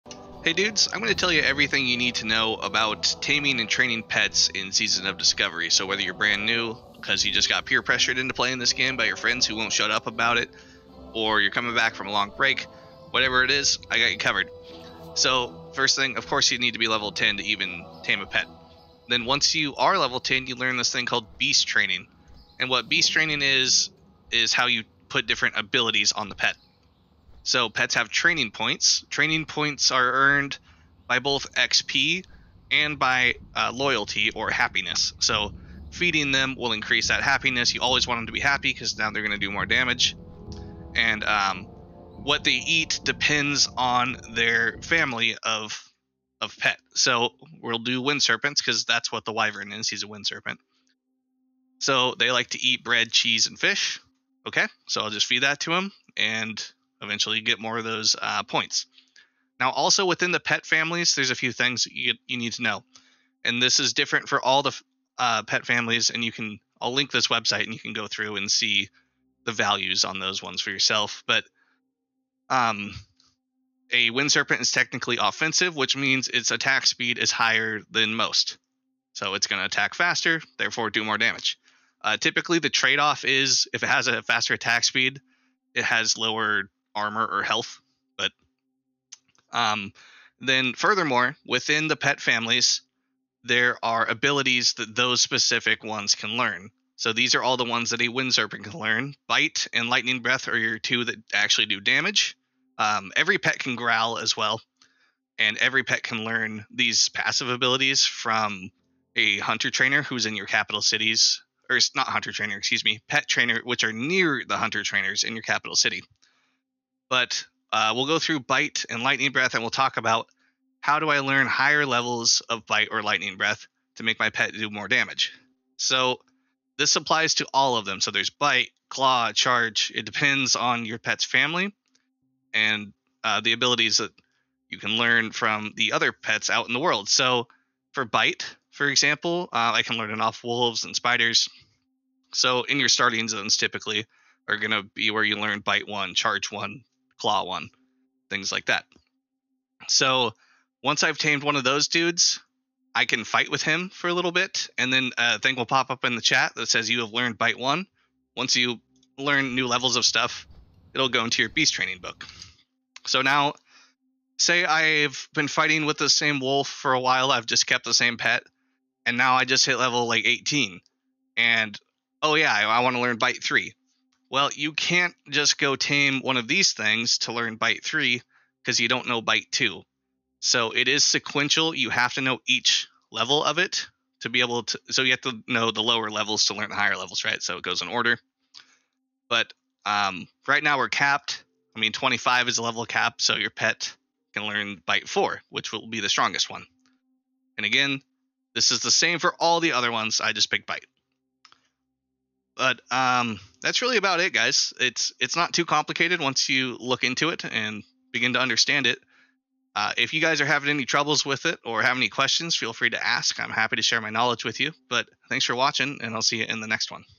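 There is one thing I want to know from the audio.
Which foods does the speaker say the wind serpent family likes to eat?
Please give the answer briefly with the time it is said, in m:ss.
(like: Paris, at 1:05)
Bread, cheese, and fish, at 0:52.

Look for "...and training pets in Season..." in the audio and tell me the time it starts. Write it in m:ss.
0:03.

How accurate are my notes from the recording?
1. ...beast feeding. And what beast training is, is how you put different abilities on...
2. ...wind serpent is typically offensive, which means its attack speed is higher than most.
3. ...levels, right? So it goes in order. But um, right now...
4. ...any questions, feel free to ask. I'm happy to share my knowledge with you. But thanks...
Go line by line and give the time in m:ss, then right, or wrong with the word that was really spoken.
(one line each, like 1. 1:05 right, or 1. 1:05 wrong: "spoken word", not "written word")
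1. 0:21 wrong: "training", not "feeding"
2. 1:14 wrong: "technically", not "typically"
3. 3:06 right
4. 3:31 right.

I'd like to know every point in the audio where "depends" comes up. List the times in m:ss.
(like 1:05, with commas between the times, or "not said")
0:43, 2:10.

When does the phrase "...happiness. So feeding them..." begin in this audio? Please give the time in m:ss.
0:34.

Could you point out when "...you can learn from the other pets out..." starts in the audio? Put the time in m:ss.
2:14.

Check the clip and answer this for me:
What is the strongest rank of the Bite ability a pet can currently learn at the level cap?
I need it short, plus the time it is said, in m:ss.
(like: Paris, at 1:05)
Bite 4, at 3:14.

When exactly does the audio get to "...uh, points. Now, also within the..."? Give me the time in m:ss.
0:58.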